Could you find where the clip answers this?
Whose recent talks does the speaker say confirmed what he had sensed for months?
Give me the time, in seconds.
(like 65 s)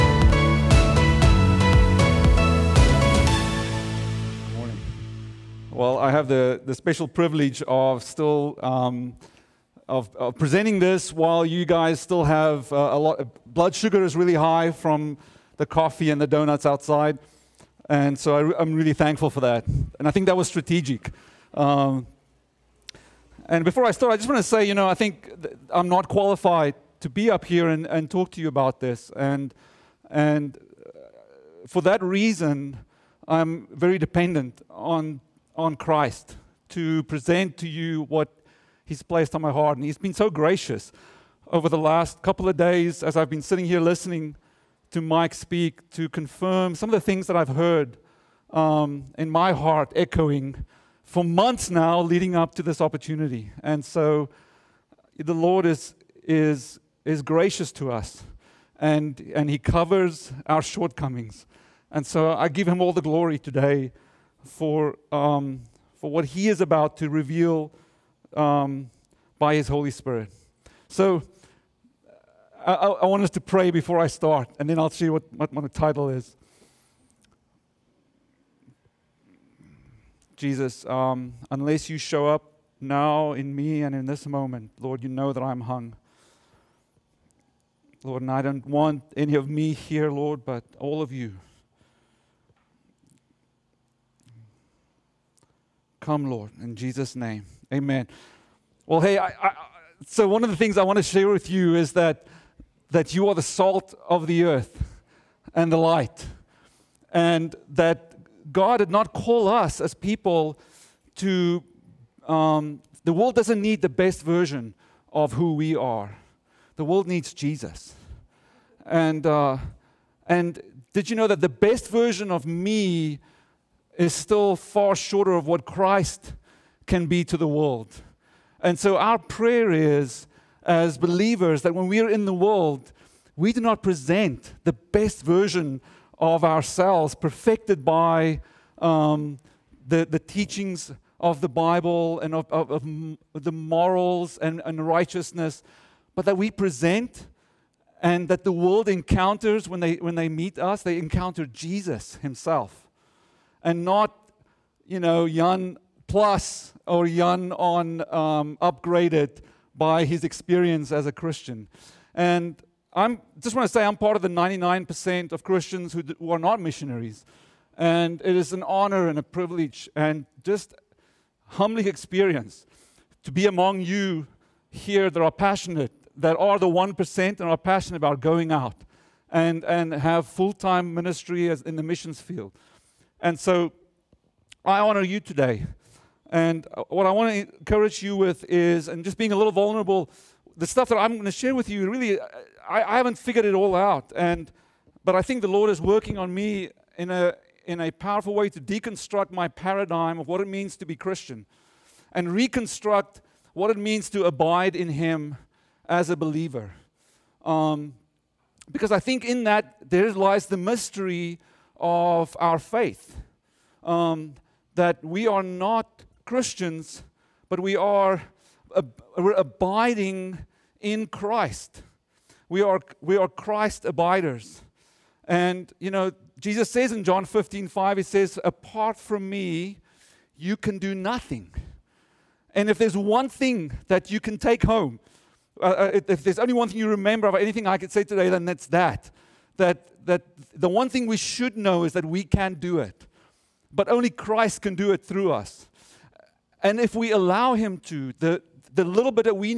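45 s.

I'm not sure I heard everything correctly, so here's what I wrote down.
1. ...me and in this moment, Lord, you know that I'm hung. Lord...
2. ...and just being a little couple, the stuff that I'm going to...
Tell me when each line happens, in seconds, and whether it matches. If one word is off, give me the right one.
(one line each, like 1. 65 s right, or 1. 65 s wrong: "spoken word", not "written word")
1. 83 s right
2. 188 s wrong: "vulnerable", not "couple".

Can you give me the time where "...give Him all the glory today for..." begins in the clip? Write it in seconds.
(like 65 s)
62 s.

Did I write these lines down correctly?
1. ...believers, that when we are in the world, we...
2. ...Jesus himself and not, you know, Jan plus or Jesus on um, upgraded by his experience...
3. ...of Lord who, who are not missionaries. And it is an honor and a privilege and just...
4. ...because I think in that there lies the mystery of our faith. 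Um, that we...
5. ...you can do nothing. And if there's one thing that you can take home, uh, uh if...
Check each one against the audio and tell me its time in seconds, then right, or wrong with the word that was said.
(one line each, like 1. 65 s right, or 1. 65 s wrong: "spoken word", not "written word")
1. 130 s right
2. 151 s wrong: "Jan", not "Jesus"
3. 165 s wrong: "Christians", not "Lord"
4. 208 s right
5. 230 s right.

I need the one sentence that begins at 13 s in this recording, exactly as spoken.
Blood sugar is really high from the coffee and the donuts outside, and so I, am really thankful for that.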